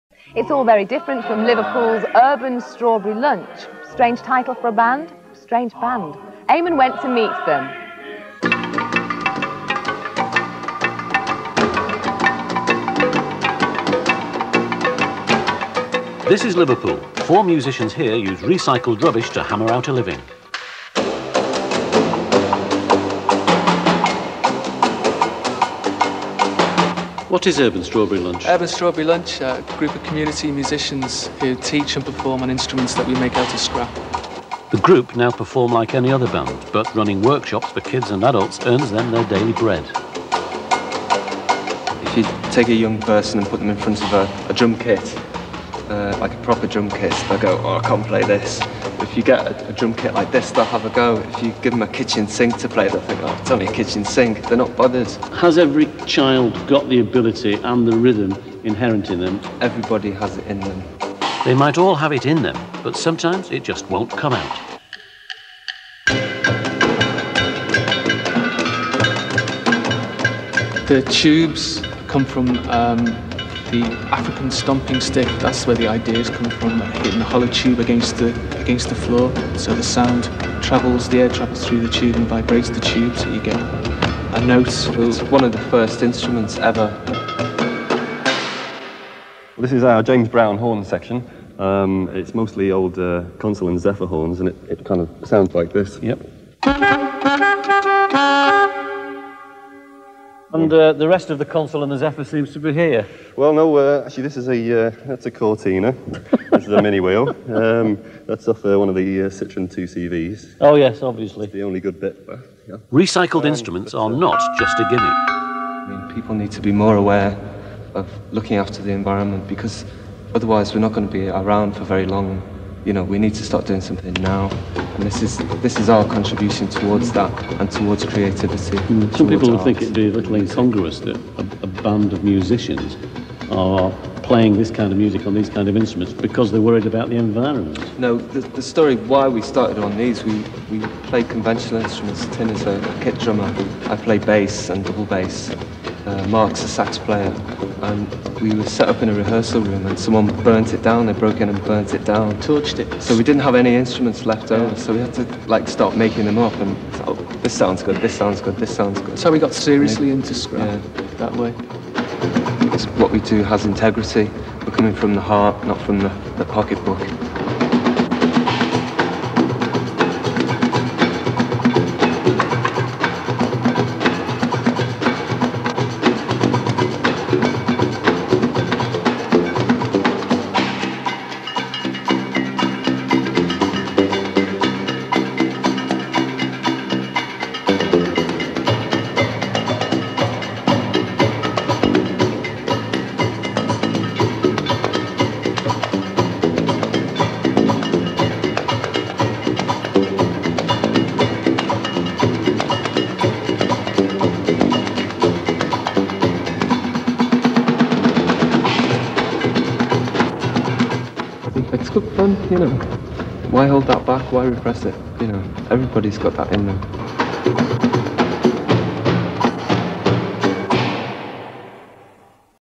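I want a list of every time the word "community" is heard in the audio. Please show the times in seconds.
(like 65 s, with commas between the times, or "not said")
30 s.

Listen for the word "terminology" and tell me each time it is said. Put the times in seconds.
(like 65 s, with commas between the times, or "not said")
not said.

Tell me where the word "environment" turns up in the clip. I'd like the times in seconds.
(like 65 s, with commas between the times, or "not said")
118 s, 137 s.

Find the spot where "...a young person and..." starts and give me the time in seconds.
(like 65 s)
42 s.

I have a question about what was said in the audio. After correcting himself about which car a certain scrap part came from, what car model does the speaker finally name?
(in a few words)
Cortina.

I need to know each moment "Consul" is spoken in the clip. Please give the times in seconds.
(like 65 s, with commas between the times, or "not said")
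93 s, 101 s.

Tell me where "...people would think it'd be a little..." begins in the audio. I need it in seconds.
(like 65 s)
129 s.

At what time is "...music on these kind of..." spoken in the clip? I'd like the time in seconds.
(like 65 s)
134 s.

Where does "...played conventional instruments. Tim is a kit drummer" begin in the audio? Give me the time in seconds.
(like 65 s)
141 s.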